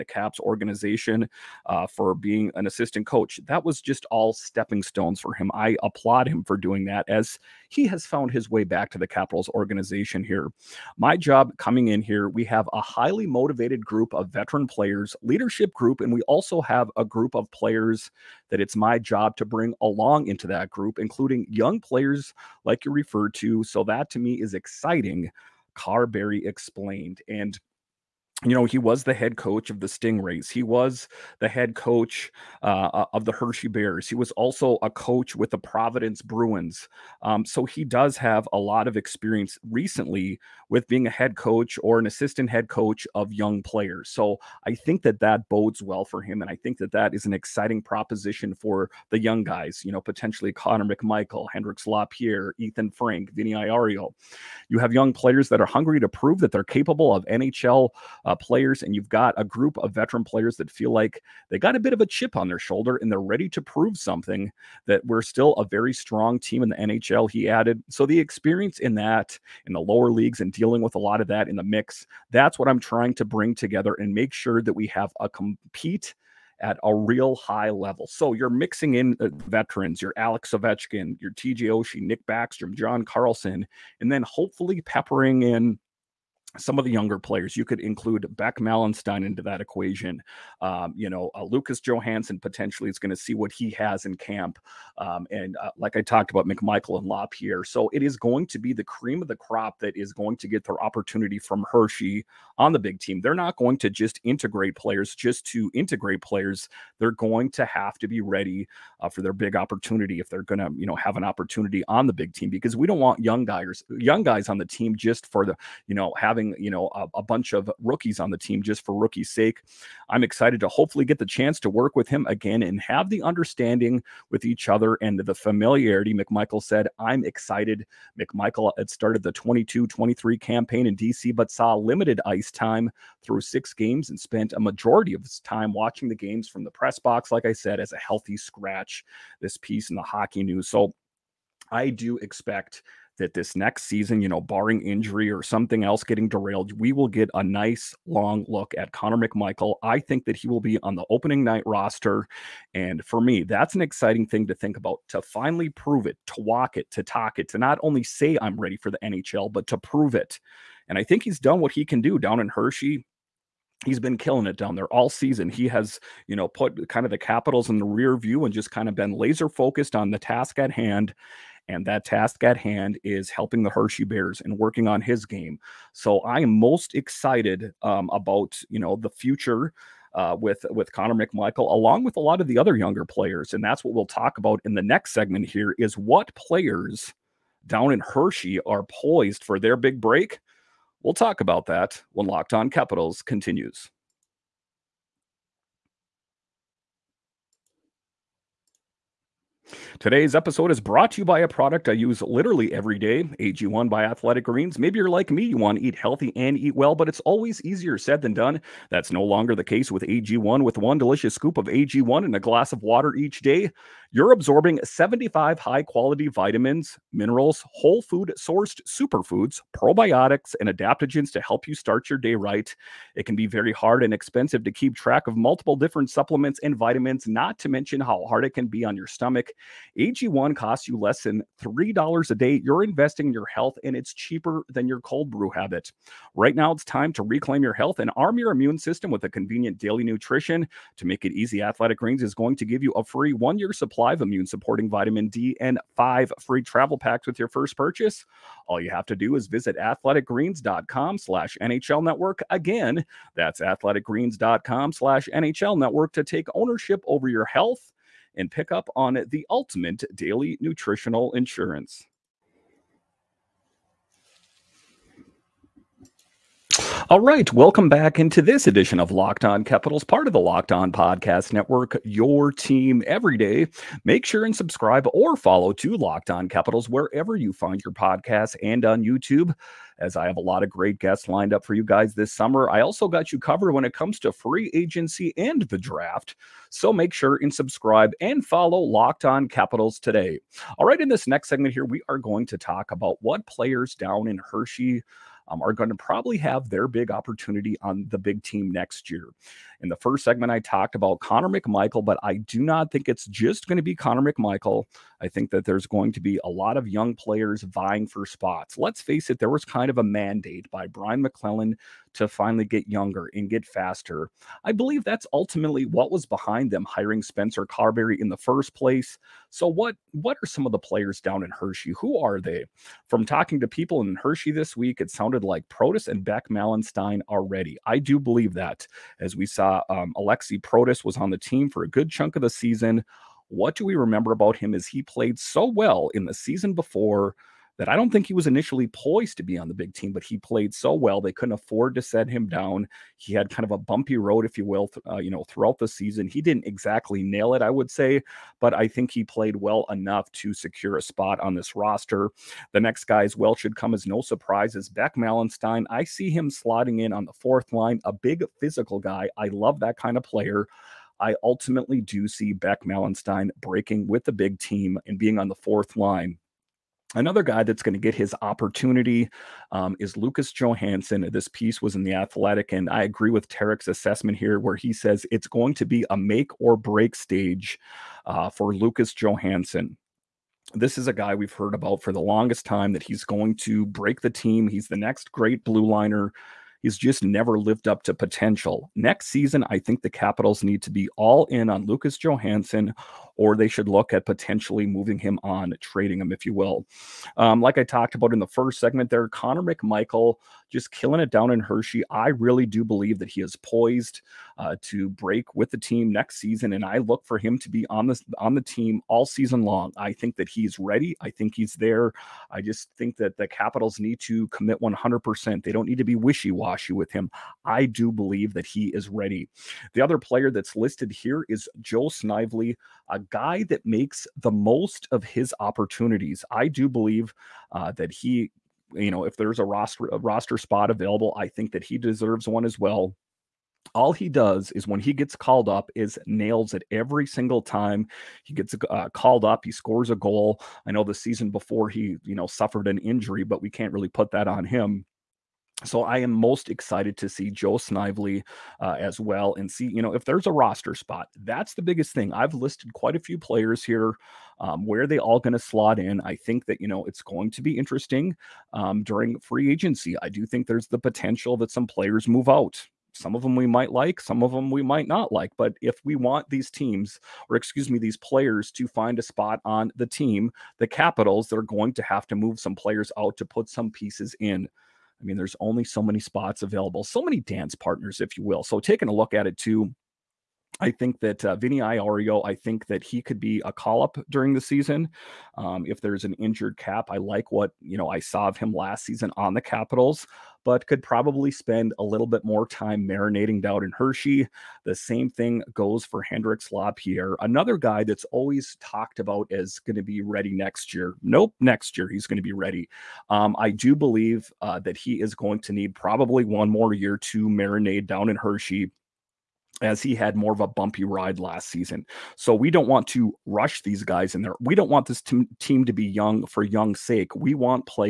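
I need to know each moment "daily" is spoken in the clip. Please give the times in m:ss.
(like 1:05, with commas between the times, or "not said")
3:59, 4:20.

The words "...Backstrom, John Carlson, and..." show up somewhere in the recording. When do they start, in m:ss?
1:22.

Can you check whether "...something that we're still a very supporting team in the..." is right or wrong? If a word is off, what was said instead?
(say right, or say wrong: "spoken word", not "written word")
wrong: "strong", not "supporting".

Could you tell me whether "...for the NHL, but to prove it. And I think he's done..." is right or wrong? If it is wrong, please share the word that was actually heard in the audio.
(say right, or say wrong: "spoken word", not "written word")
right.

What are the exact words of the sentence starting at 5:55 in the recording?
I see him slotting in on the fourth line, a big physical guy.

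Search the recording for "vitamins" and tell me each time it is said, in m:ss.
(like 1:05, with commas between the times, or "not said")
3:36, 3:46, 4:04.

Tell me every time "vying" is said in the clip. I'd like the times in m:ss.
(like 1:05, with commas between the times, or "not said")
5:07.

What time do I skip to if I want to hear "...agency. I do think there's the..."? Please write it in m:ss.
7:39.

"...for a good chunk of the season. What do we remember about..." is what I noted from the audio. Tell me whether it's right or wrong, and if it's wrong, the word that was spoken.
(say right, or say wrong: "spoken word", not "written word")
right.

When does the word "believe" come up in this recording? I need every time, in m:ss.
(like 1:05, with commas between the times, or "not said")
5:14, 5:28, 6:42, 6:58, 7:06, 8:23.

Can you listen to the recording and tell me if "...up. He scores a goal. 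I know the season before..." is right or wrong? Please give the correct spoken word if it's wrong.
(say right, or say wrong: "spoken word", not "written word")
right.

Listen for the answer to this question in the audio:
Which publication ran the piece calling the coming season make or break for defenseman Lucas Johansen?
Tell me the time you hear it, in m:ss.
6:12.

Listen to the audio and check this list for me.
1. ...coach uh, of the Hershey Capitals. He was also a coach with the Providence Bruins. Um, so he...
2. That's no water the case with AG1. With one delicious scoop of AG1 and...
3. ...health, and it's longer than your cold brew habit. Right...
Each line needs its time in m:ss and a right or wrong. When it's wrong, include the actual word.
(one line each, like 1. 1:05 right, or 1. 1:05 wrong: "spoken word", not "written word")
1. 0:31 wrong: "Bears", not "Capitals"
2. 3:28 wrong: "longer", not "water"
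3. 3:53 wrong: "cheaper", not "longer".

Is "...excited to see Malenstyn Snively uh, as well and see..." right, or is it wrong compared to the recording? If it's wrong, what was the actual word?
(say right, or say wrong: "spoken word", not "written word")
wrong: "Joe", not "Malenstyn".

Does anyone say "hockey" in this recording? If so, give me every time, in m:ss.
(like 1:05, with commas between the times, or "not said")
2:20.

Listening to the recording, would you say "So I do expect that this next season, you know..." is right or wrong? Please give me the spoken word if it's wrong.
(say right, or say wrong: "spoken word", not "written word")
right.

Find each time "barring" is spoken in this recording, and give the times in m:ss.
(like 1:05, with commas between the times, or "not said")
2:24.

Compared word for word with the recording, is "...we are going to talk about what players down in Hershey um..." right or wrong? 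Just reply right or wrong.
right.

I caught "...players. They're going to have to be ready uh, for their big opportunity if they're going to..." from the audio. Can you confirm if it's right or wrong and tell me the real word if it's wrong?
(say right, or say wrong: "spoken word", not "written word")
right.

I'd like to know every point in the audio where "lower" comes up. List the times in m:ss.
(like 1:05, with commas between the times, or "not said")
1:09.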